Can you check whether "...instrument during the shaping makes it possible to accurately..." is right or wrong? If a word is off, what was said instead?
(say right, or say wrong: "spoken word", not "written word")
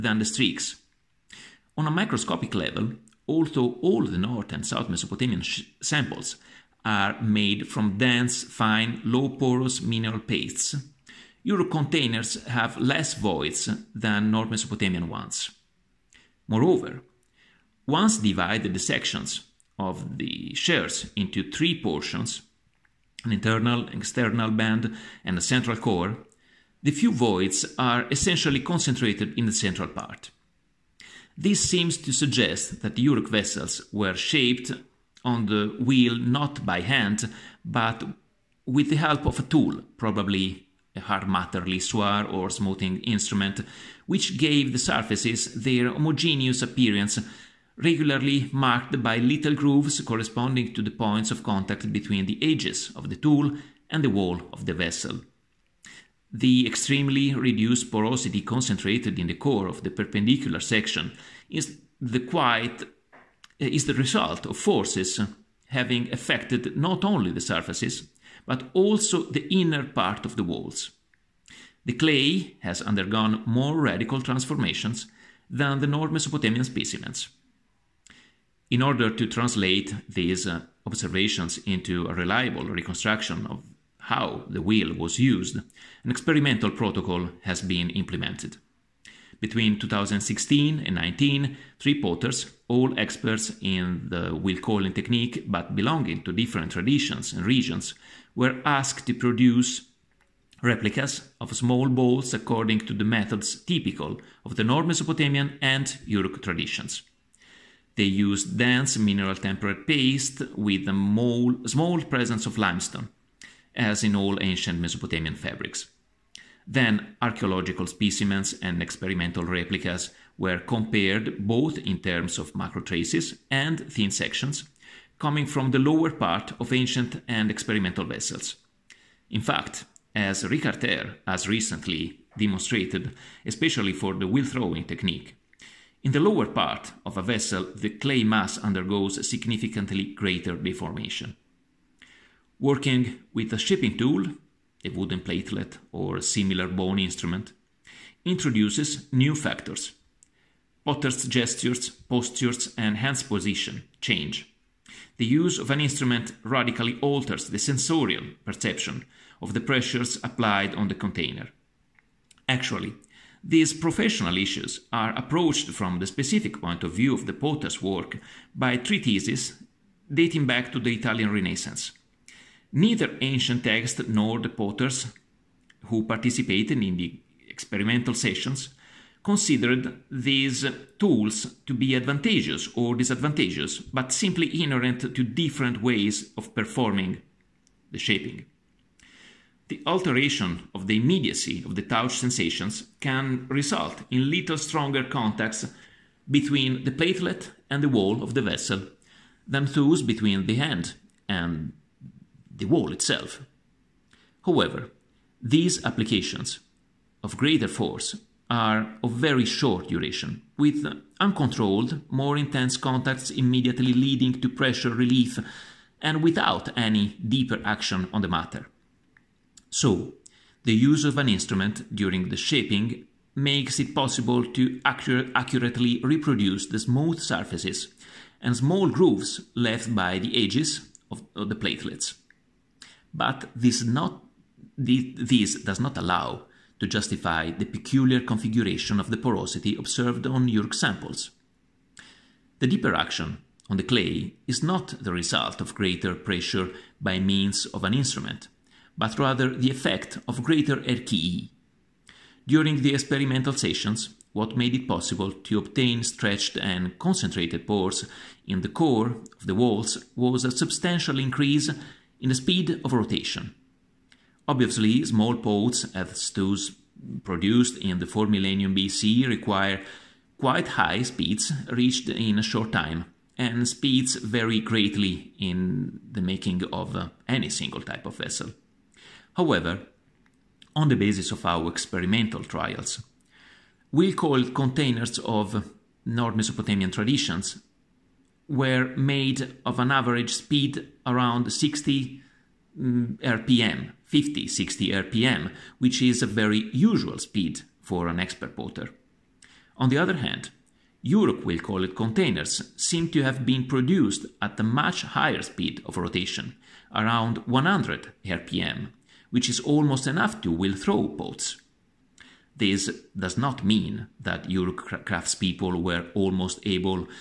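right.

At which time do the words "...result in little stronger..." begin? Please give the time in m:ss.
3:13.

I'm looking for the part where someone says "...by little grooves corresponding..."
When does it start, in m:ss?
0:49.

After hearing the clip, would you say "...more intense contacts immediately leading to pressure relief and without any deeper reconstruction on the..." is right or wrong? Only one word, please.
wrong.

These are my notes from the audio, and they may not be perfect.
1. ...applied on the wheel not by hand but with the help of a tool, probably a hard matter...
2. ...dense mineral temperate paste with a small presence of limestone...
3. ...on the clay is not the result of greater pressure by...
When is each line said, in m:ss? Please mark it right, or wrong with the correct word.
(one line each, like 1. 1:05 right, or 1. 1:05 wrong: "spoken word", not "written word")
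1. 0:34 wrong: "shaped", not "applied"
2. 1:48 right
3. 4:03 right.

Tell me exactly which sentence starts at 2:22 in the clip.
Working with a shaping tool, a wooden platelet or a similar bone instrument, introduces new factors.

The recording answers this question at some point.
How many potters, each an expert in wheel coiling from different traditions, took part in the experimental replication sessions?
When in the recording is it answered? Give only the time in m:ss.
1:31.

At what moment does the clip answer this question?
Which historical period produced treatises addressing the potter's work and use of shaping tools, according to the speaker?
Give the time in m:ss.
2:50.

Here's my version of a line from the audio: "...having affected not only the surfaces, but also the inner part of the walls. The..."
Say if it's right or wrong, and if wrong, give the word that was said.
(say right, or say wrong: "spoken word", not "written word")
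right.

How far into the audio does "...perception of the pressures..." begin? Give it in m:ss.
2:38.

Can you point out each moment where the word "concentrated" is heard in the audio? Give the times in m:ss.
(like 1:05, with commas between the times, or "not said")
0:28, 0:58, 4:16.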